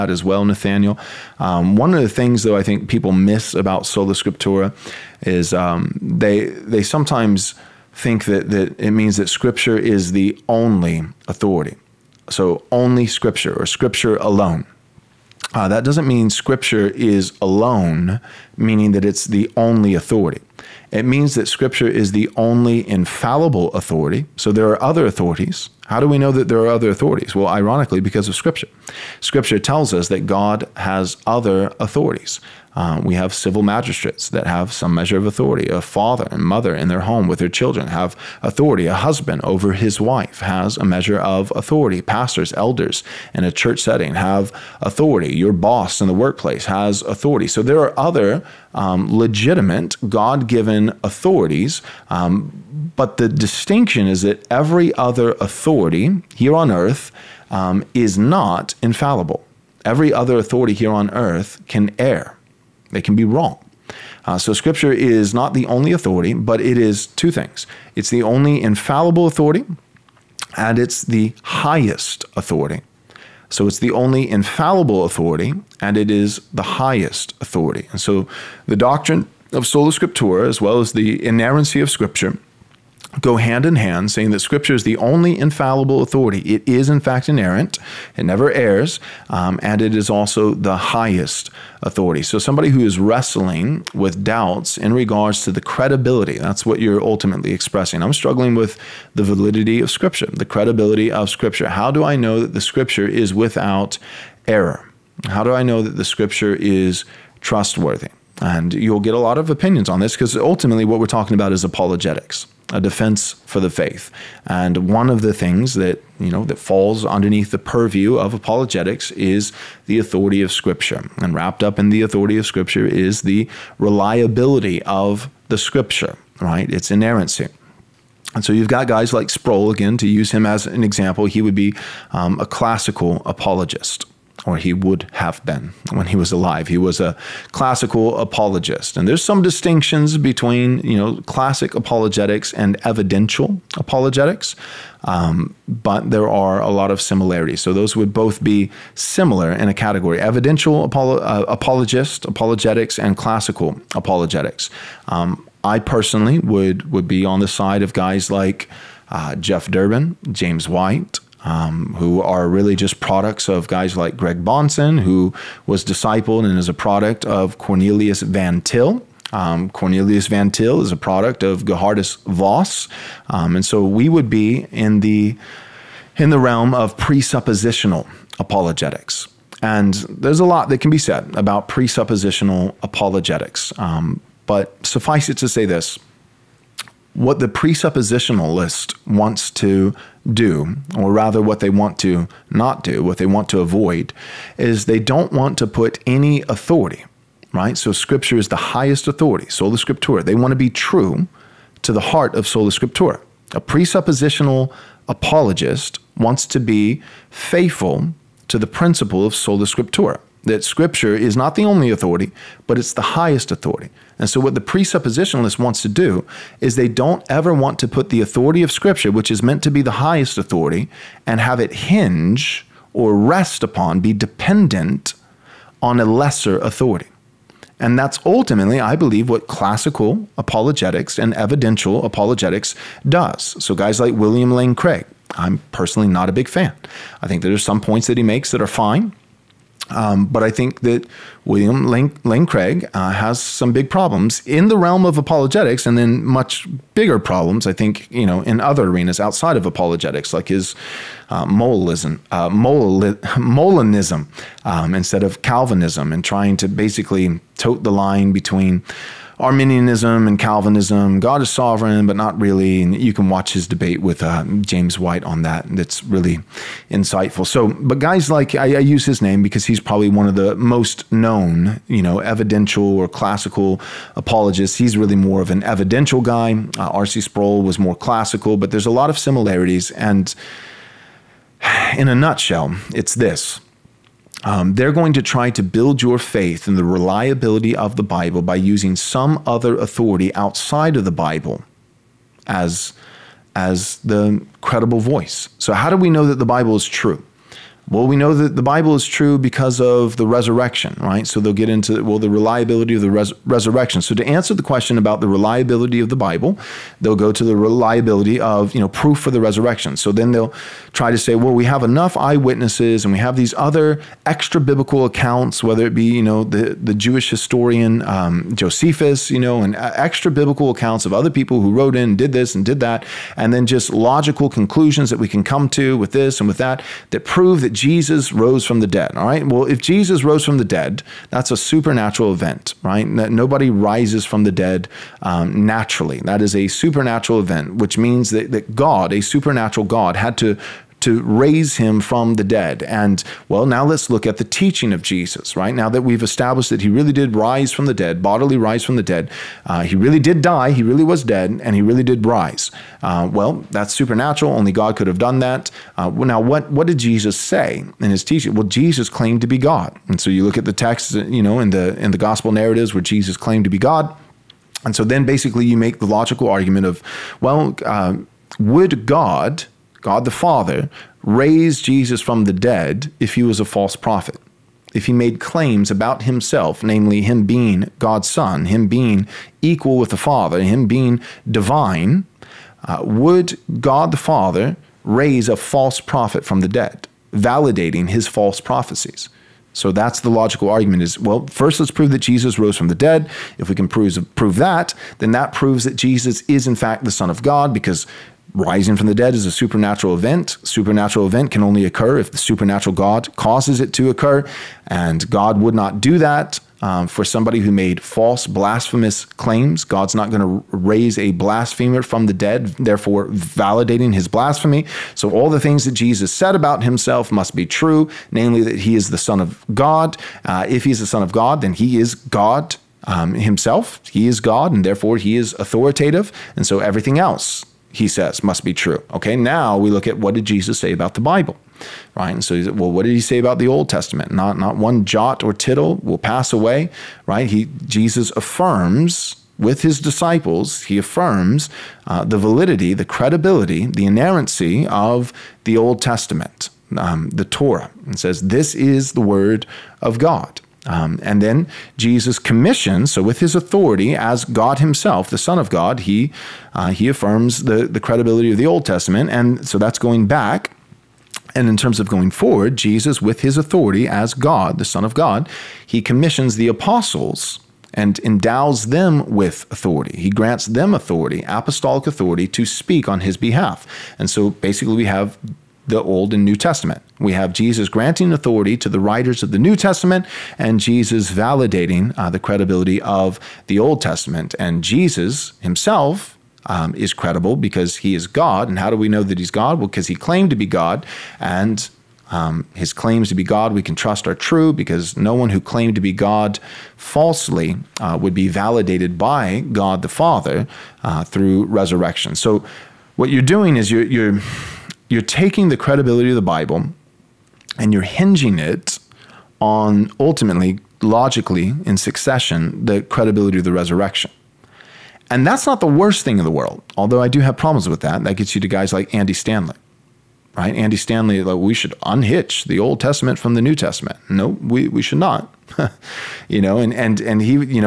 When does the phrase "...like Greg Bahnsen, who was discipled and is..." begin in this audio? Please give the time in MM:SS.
02:43.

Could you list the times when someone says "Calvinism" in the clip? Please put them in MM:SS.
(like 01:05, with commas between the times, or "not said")
04:15, 04:20.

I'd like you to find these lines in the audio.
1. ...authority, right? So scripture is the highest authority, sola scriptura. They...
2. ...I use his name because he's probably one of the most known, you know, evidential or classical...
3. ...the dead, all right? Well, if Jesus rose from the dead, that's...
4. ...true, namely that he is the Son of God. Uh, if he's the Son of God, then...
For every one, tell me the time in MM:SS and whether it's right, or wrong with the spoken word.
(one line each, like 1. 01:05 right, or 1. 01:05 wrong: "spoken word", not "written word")
1. 03:16 right
2. 04:28 right
3. 05:28 right
4. 06:57 right.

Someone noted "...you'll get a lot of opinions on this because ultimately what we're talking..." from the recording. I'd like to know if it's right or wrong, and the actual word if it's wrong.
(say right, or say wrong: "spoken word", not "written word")
right.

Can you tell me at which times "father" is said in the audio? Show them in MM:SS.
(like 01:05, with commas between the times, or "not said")
00:35, 06:10, 06:20, 06:24, 08:20.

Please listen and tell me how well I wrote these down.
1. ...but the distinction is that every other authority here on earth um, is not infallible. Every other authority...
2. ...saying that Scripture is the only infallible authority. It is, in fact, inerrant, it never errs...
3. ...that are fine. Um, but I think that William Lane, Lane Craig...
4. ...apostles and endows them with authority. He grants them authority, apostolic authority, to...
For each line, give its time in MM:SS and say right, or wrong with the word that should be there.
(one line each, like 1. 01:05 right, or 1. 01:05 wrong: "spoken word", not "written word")
1. 00:52 right
2. 01:24 right
3. 03:58 right
4. 07:46 right.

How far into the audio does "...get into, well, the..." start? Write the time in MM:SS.
05:01.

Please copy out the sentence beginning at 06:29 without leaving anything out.
So that's the logical argument is well, first let's prove that Jesus rose from the dead.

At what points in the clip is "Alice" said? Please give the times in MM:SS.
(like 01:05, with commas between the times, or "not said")
not said.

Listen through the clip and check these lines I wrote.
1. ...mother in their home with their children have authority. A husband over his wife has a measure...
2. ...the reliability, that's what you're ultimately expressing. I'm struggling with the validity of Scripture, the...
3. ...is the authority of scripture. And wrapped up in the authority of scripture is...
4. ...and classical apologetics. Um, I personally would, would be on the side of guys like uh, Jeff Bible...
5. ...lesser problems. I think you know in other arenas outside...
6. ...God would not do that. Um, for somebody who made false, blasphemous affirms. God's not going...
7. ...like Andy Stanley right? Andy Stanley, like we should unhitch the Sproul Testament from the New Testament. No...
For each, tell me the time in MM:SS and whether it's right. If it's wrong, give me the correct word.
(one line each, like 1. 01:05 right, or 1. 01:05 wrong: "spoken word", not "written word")
1. 00:36 right
2. 01:35 wrong: "credibility", not "reliability"
3. 01:59 right
4. 02:32 wrong: "Durbin", not "Bible"
5. 04:06 wrong: "bigger", not "lesser"
6. 06:45 wrong: "claims", not "affirms"
7. 08:38 wrong: "Old", not "Sproul".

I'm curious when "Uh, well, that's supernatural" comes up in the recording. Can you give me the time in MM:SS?
05:53.